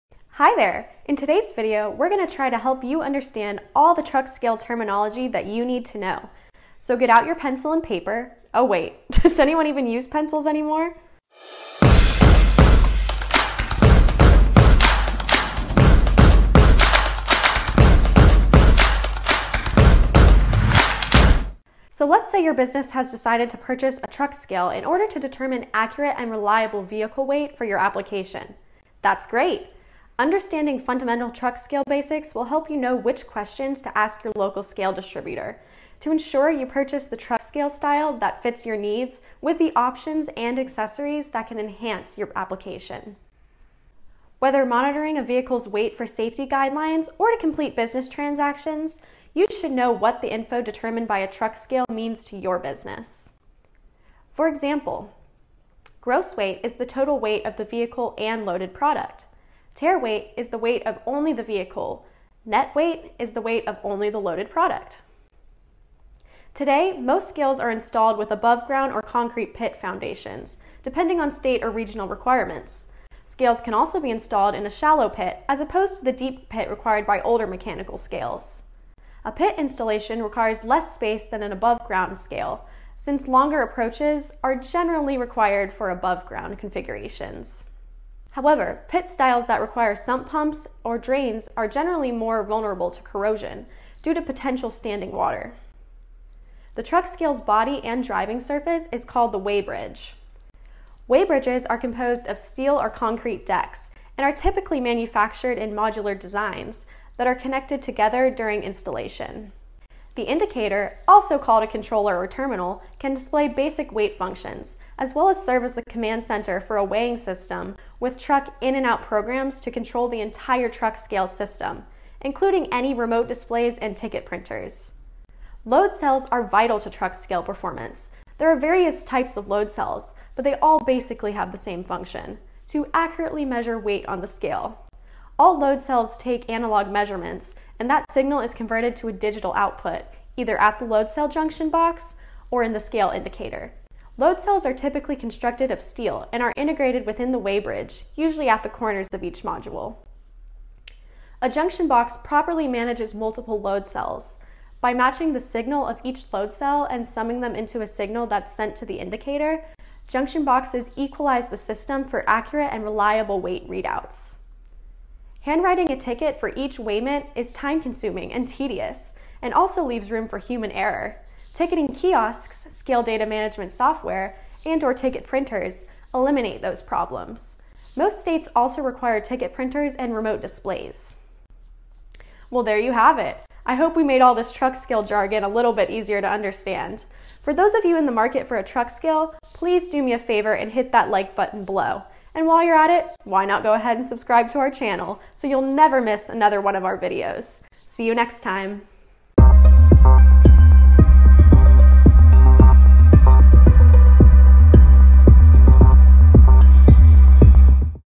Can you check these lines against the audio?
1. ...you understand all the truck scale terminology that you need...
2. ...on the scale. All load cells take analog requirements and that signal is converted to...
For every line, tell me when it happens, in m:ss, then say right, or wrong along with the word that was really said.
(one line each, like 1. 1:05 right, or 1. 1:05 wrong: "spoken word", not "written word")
1. 0:02 right
2. 2:14 wrong: "measurements", not "requirements".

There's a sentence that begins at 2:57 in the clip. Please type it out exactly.
Most states also require ticket printers and remote displays.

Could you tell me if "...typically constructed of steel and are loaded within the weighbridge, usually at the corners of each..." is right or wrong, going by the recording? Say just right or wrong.
wrong.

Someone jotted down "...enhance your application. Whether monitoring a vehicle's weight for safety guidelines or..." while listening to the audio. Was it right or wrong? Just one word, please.
right.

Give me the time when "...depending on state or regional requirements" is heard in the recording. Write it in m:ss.
1:10.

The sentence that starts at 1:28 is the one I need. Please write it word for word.
However, pit styles that require sump pumps or drains are generally more vulnerable to corrosion due to potential standing water.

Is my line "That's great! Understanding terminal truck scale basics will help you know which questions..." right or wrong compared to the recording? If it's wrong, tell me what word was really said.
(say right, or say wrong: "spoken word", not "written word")
wrong: "fundamental", not "terminal".